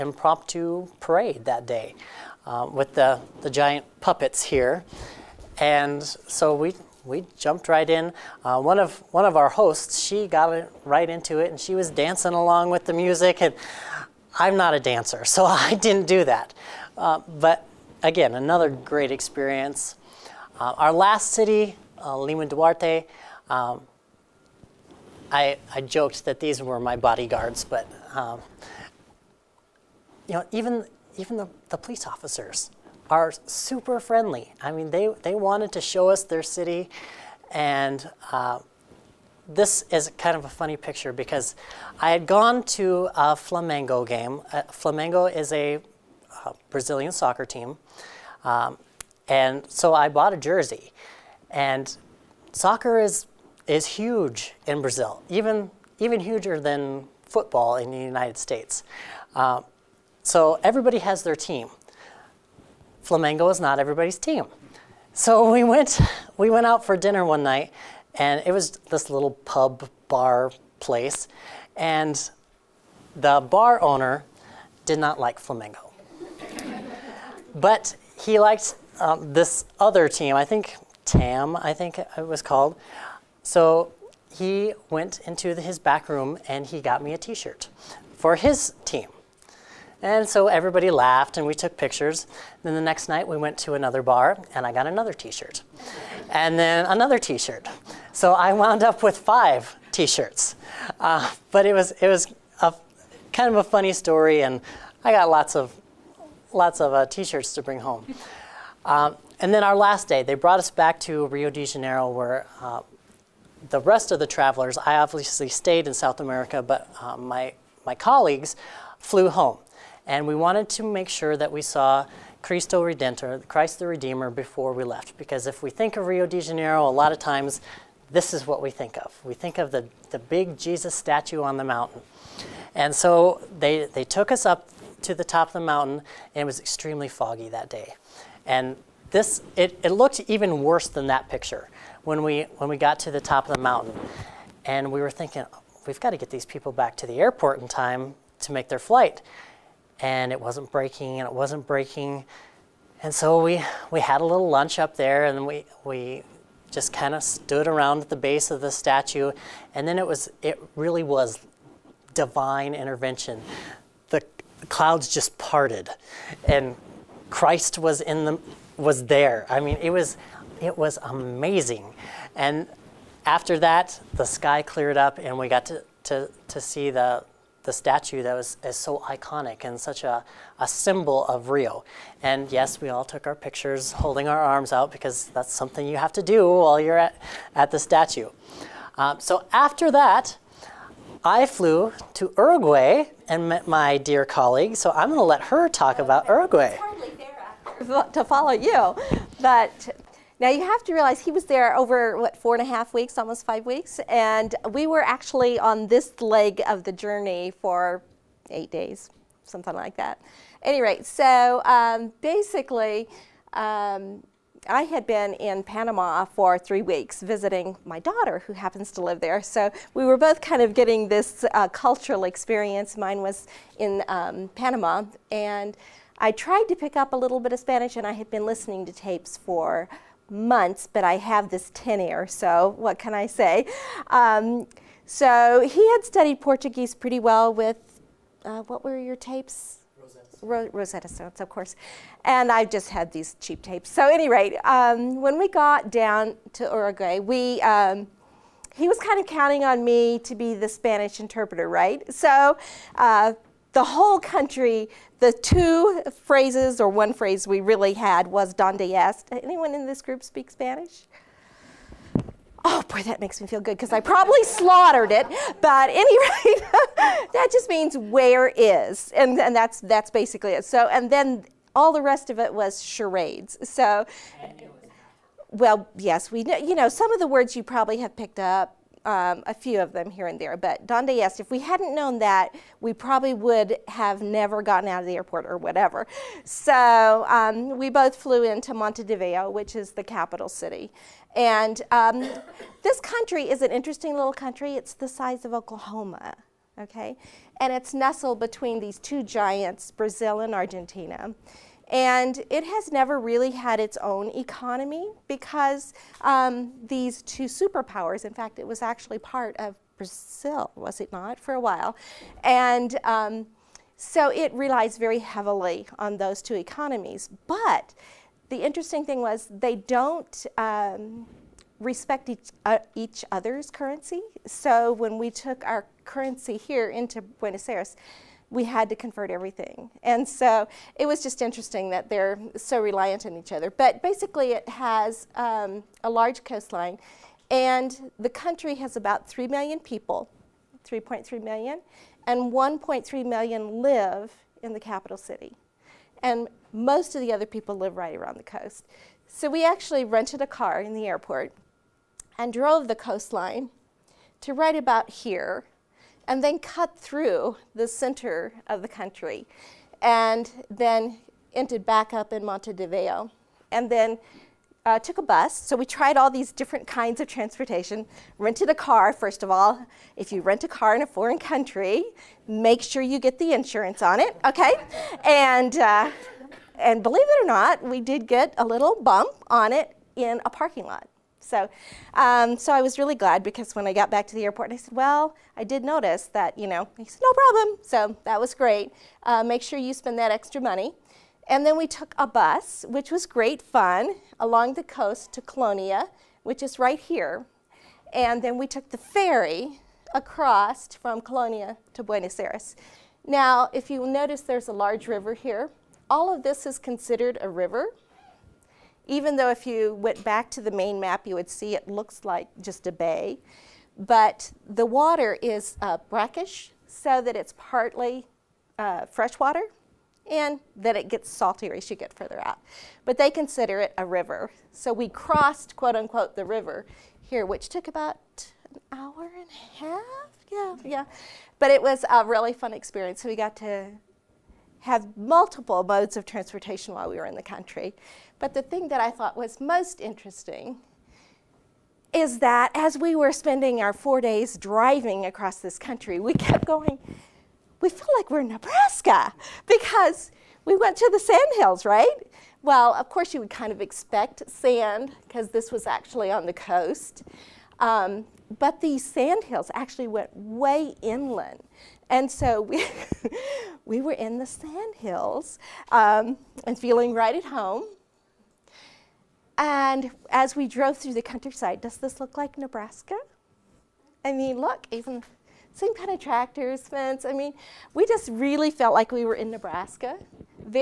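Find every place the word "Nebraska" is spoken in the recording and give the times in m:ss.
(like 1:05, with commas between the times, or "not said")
7:28, 7:52, 7:59.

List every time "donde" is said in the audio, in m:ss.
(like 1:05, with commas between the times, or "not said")
4:18, 4:40.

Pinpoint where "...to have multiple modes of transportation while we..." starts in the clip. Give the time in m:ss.
7:13.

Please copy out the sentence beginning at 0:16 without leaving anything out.
Uh, but again, another great experience.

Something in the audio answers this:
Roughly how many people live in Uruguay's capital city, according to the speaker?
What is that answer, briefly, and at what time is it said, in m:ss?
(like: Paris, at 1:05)
1.3 million, at 5:42.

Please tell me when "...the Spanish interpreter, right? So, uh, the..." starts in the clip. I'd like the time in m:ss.
4:10.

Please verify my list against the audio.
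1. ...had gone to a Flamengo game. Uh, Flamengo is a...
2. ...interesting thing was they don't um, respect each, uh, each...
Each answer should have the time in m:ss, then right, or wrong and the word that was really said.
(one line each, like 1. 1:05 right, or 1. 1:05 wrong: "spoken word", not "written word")
1. 0:42 right
2. 5:18 right.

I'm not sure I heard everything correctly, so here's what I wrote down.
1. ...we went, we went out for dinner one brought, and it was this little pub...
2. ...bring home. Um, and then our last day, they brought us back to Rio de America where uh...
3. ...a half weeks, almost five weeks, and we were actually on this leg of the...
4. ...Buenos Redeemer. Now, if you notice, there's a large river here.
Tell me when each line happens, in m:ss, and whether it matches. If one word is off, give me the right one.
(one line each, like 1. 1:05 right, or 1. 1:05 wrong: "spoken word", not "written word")
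1. 1:05 wrong: "night", not "brought"
2. 1:47 wrong: "Janeiro", not "America"
3. 3:22 right
4. 6:42 wrong: "Aires", not "Redeemer".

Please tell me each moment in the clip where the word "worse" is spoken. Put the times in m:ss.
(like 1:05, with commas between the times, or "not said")
2:20.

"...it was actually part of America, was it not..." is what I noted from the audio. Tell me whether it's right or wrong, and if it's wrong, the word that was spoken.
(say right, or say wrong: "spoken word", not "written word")
wrong: "Brazil", not "America".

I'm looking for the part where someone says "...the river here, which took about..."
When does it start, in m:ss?
7:06.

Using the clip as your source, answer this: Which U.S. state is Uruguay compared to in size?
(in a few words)
Oklahoma.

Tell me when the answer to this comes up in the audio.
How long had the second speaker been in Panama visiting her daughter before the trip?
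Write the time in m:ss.
3:36.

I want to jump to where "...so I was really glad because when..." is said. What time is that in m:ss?
6:22.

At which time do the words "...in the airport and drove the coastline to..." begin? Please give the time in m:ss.
5:50.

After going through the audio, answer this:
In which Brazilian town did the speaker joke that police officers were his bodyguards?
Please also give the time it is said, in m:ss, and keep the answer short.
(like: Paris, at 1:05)
Lima Duarte, at 0:22.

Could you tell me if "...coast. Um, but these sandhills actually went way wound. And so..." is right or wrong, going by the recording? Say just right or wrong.
wrong.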